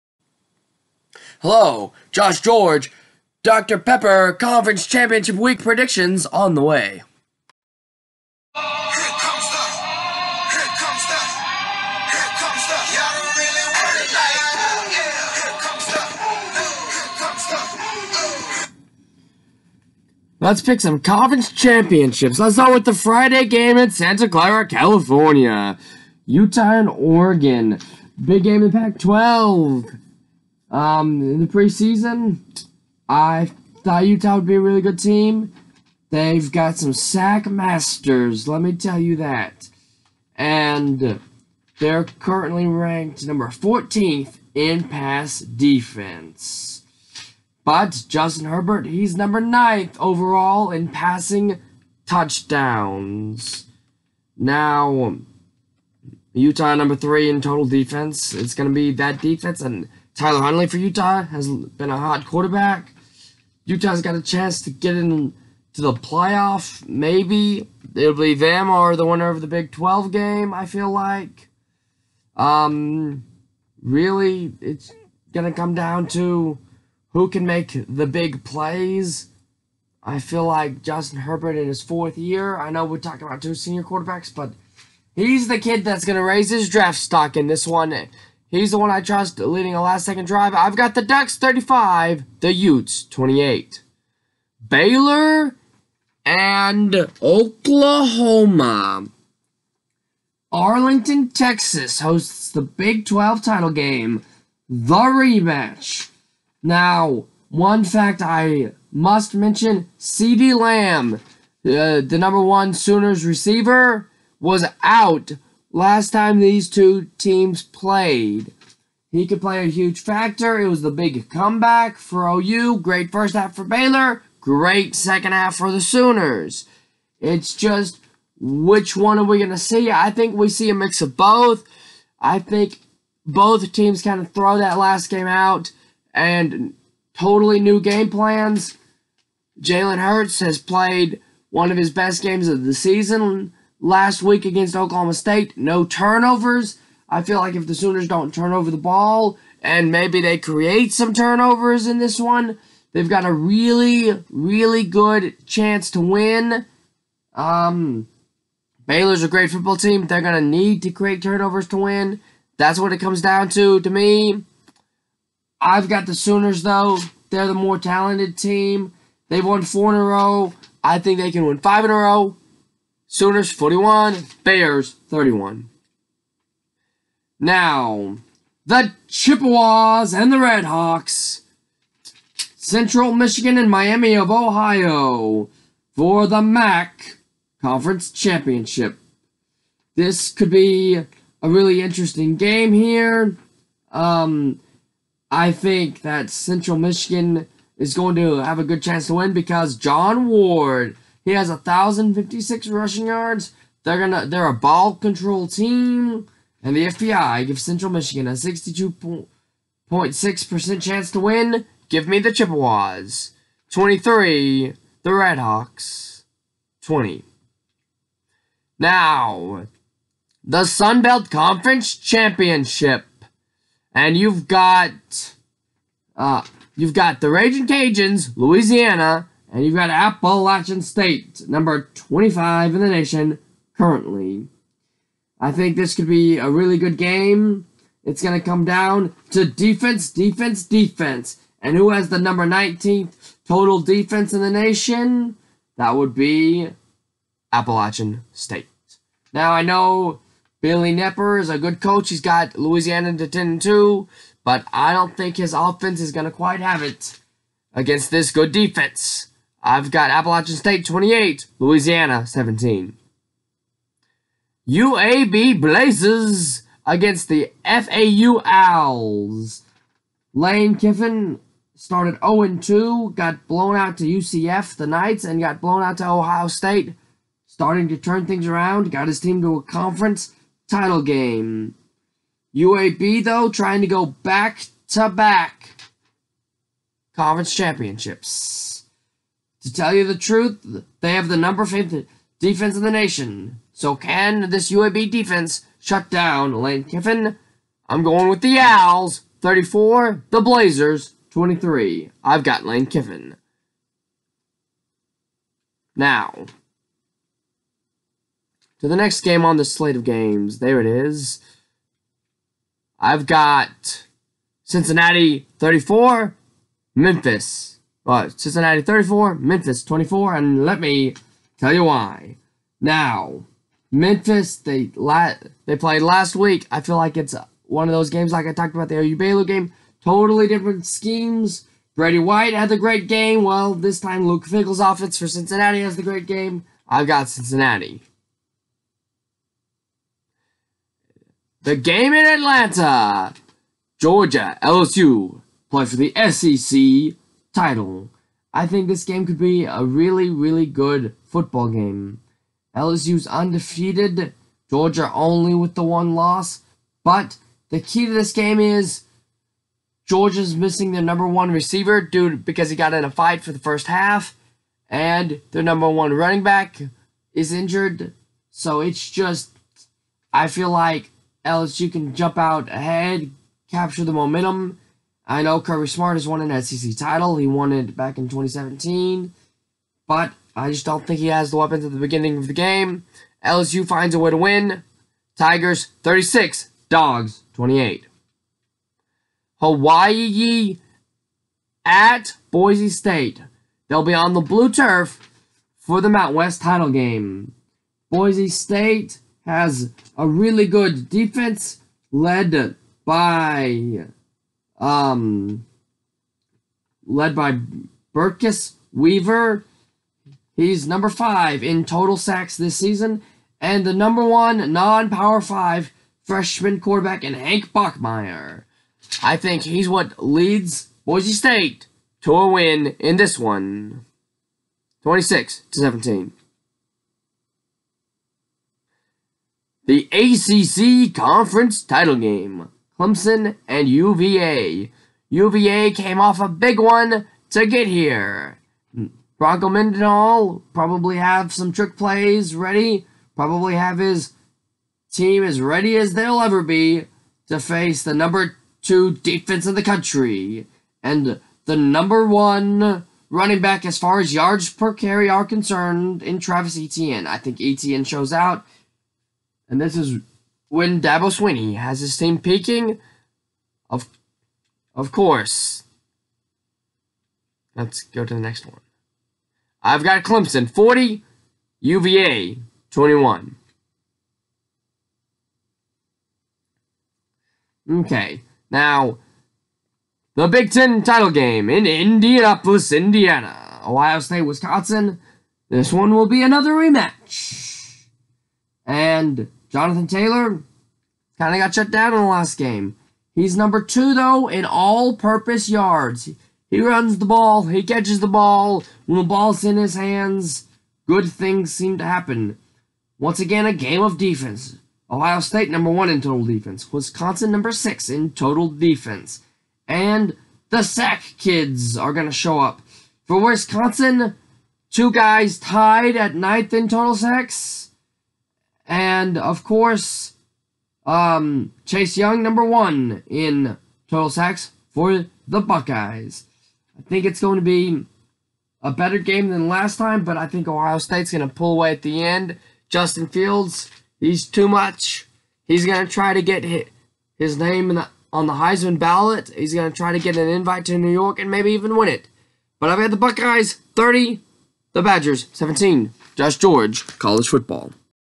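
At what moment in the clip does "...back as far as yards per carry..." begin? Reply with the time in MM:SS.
07:33.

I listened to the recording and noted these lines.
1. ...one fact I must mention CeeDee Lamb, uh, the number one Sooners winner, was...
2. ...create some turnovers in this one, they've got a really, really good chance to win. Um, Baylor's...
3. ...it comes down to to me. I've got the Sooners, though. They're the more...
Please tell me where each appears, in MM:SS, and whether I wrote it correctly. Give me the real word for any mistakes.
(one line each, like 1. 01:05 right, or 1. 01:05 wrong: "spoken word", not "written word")
1. 01:47 wrong: "receiver", not "winner"
2. 02:30 right
3. 02:42 right.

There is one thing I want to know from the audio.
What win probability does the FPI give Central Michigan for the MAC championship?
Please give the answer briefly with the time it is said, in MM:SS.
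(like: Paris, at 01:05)
62.6%, at 03:28.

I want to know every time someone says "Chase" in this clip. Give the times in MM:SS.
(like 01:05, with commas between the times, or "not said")
08:41.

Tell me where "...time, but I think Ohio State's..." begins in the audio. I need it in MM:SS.
08:49.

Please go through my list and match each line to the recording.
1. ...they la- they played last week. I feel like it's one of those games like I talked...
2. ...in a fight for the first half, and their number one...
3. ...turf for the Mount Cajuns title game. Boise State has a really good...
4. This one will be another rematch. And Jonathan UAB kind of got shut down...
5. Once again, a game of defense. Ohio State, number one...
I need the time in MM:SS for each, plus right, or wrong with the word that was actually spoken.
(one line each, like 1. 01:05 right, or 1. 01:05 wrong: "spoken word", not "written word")
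1. 05:24 right
2. 06:02 right
3. 06:34 wrong: "West", not "Cajuns"
4. 08:05 wrong: "Taylor", not "UAB"
5. 08:23 right.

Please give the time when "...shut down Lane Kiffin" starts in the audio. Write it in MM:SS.
04:55.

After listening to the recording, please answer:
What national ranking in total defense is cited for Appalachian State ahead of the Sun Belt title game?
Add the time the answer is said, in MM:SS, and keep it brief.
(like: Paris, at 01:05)
19th, at 04:02.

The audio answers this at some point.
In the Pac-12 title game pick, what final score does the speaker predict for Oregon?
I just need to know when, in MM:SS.
01:31.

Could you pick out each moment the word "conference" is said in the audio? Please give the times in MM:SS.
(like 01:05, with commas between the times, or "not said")
00:04, 00:20, 03:07, 03:41, 04:39, 04:47, 07:11.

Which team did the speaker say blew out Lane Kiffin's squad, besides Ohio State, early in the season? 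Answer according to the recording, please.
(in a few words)
UCF.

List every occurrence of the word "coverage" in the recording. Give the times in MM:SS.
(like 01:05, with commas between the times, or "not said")
not said.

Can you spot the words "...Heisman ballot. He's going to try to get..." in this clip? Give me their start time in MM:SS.
08:58.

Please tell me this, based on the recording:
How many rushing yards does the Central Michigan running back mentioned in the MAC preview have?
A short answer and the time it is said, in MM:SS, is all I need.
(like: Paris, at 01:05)
1,056, at 03:21.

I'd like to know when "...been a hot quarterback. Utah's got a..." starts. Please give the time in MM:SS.
01:01.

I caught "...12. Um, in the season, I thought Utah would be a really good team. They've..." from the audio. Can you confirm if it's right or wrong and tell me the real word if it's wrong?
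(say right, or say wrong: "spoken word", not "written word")
wrong: "preseason", not "season".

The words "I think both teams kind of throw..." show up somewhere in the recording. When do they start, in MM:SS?
02:12.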